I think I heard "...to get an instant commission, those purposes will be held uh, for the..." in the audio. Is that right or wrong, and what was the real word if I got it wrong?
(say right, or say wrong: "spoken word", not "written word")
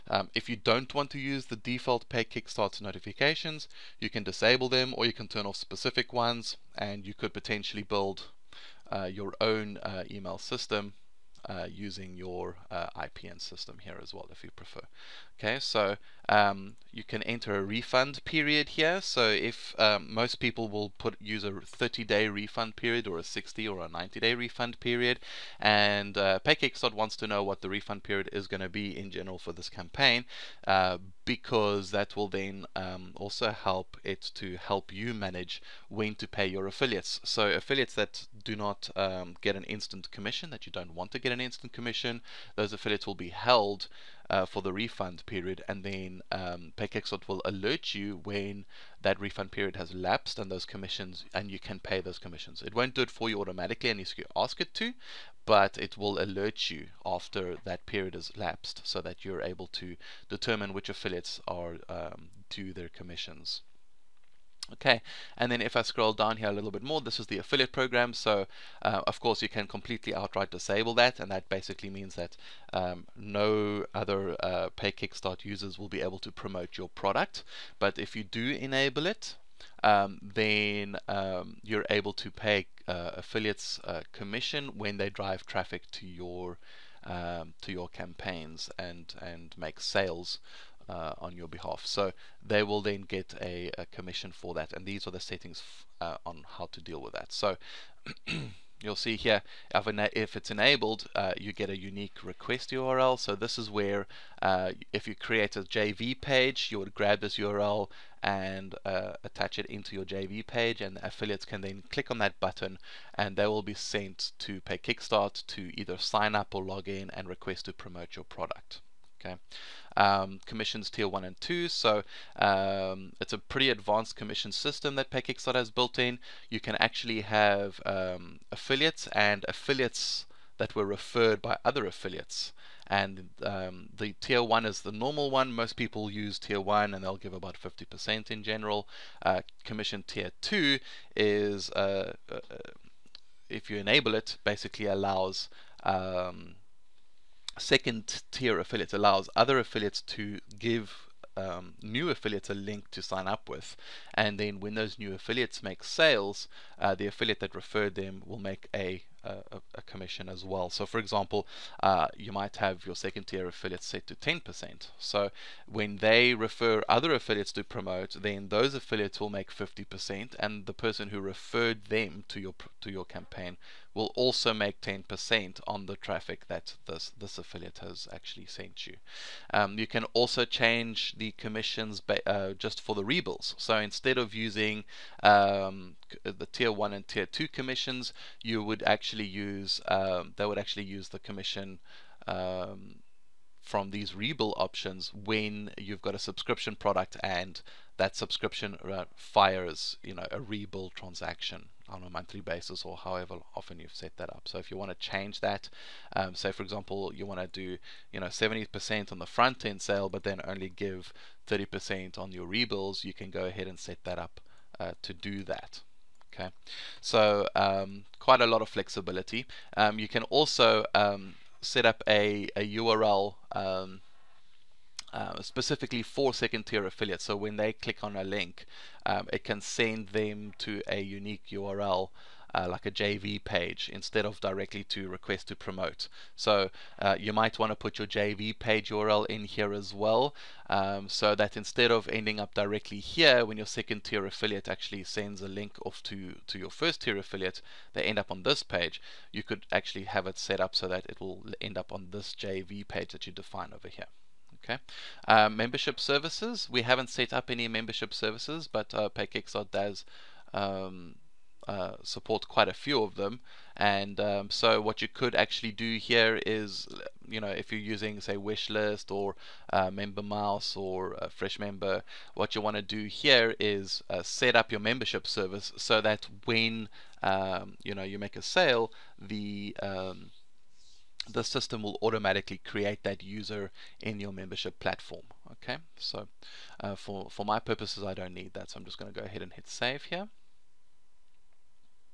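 wrong: "affiliates", not "purposes".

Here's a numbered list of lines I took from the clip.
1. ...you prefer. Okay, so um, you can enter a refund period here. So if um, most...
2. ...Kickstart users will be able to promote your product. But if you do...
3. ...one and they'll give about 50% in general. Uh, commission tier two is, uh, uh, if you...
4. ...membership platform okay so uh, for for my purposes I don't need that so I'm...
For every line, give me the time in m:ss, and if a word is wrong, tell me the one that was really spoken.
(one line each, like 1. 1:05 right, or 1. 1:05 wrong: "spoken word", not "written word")
1. 0:14 right
2. 1:14 right
3. 2:16 right
4. 4:44 right.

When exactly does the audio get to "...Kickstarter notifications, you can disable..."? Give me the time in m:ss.
0:02.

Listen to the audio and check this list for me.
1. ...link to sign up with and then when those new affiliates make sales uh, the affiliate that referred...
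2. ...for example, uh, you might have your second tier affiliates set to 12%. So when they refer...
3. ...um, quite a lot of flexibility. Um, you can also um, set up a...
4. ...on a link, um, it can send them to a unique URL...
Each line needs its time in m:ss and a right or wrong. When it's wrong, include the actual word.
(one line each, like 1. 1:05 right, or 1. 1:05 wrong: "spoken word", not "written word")
1. 2:32 right
2. 2:40 wrong: "10", not "12"
3. 3:37 right
4. 3:48 right.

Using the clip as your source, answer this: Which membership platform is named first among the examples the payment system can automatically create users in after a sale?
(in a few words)
Wishlist.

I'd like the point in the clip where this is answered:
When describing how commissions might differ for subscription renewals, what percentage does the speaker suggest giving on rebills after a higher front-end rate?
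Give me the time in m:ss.
3:31.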